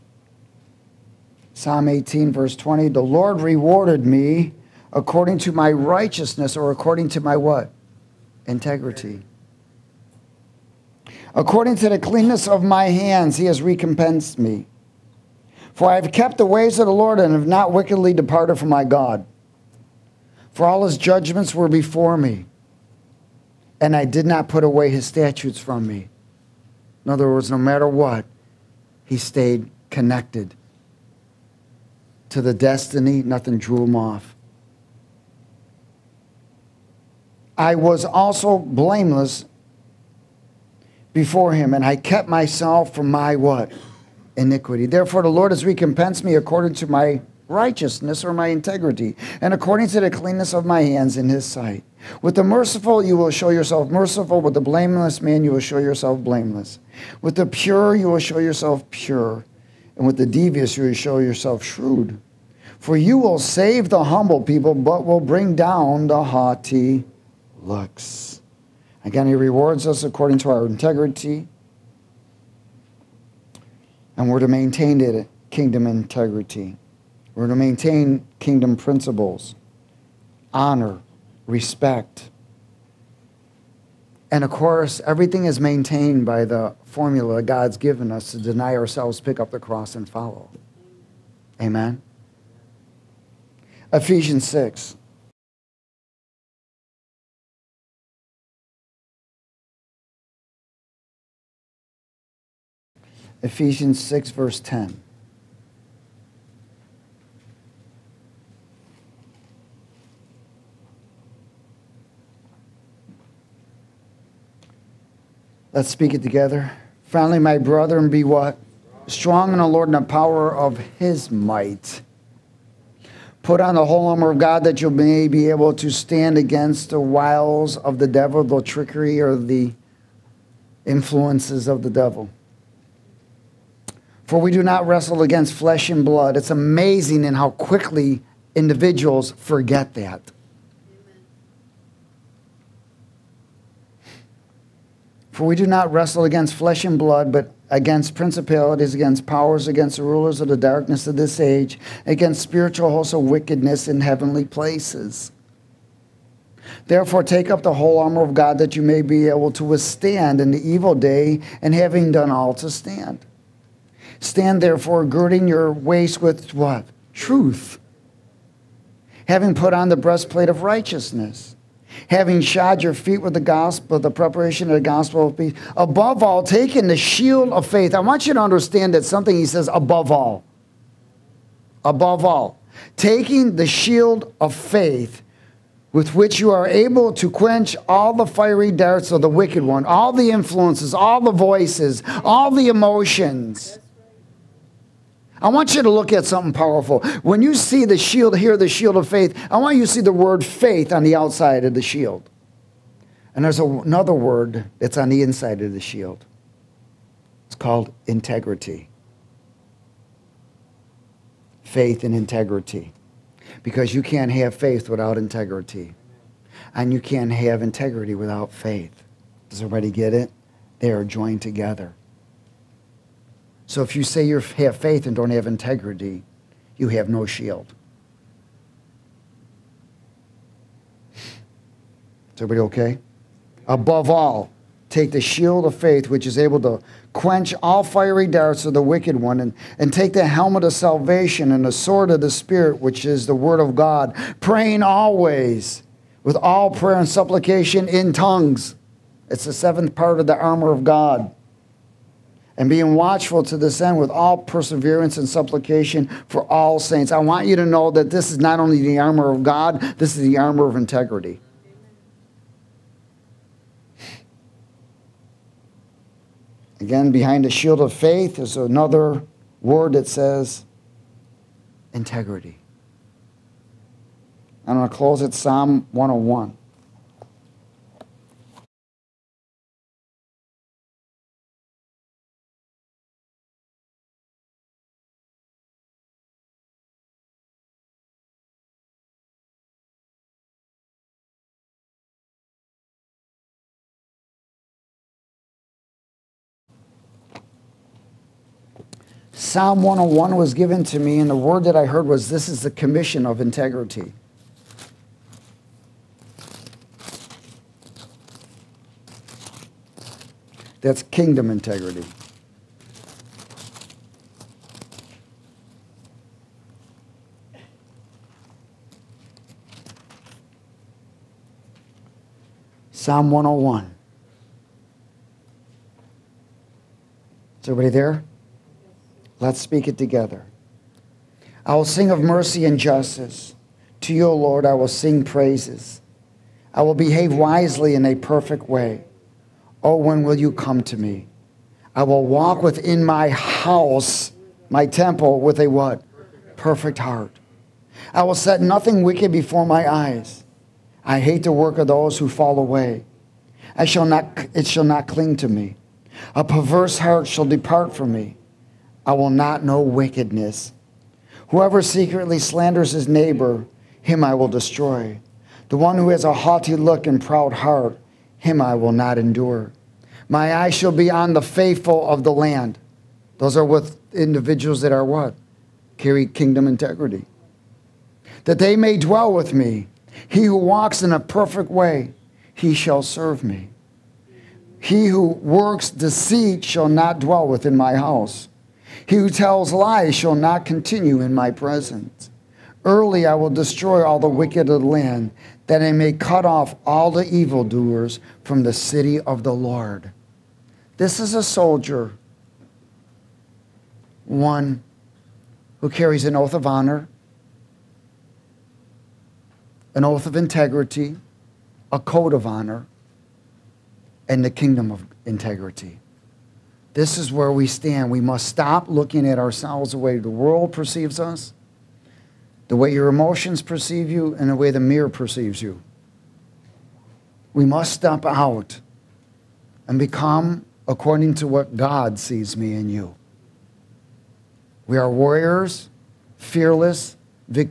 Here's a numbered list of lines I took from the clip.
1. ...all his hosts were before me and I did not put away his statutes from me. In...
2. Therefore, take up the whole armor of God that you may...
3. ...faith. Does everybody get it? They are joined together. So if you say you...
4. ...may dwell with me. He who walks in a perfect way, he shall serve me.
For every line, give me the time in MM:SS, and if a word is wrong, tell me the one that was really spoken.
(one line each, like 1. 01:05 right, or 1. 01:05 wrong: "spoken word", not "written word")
1. 00:20 wrong: "judgments", not "hosts"
2. 02:36 right
3. 03:38 right
4. 06:18 right.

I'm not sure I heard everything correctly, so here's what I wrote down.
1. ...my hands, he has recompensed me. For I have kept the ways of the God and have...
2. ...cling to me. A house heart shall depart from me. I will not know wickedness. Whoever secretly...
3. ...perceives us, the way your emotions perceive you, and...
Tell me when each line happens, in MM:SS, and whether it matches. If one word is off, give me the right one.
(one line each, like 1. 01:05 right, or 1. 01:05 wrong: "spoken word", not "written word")
1. 00:12 wrong: "Lord", not "God"
2. 05:55 wrong: "perverse", not "house"
3. 07:00 right.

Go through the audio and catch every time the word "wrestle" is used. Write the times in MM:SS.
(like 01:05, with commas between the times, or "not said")
02:14, 02:25.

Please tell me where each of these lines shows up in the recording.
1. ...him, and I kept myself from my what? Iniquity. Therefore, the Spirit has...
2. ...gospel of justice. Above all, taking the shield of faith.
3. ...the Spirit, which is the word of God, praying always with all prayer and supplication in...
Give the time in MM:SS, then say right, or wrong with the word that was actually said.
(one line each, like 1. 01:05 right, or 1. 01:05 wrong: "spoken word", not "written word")
1. 00:41 wrong: "Lord", not "Spirit"
2. 02:54 wrong: "peace", not "justice"
3. 04:02 right.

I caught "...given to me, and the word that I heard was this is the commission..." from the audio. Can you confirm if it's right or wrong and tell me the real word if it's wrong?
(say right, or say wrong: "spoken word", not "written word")
right.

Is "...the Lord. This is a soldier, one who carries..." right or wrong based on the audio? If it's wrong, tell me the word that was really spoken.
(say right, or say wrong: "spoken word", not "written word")
right.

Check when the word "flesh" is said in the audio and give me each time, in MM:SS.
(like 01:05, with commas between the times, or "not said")
02:15, 02:26.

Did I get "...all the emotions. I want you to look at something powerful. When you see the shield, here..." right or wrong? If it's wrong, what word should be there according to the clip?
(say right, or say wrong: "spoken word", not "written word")
right.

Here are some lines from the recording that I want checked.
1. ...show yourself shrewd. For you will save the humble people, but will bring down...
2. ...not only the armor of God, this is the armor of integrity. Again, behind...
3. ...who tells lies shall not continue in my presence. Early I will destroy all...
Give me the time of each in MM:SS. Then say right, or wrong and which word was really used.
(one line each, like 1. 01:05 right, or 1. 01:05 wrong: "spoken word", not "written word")
1. 01:00 right
2. 04:18 right
3. 06:29 right.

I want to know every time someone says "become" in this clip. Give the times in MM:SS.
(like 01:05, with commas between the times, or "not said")
07:09.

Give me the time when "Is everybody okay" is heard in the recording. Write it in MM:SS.
03:51.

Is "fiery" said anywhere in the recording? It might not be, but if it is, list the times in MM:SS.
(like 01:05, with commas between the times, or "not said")
03:08, 03:57.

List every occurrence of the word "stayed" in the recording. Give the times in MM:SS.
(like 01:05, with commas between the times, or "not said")
00:29.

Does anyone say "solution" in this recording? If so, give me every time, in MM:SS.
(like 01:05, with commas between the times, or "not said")
not said.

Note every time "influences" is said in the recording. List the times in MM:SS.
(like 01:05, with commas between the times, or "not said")
02:10, 03:10.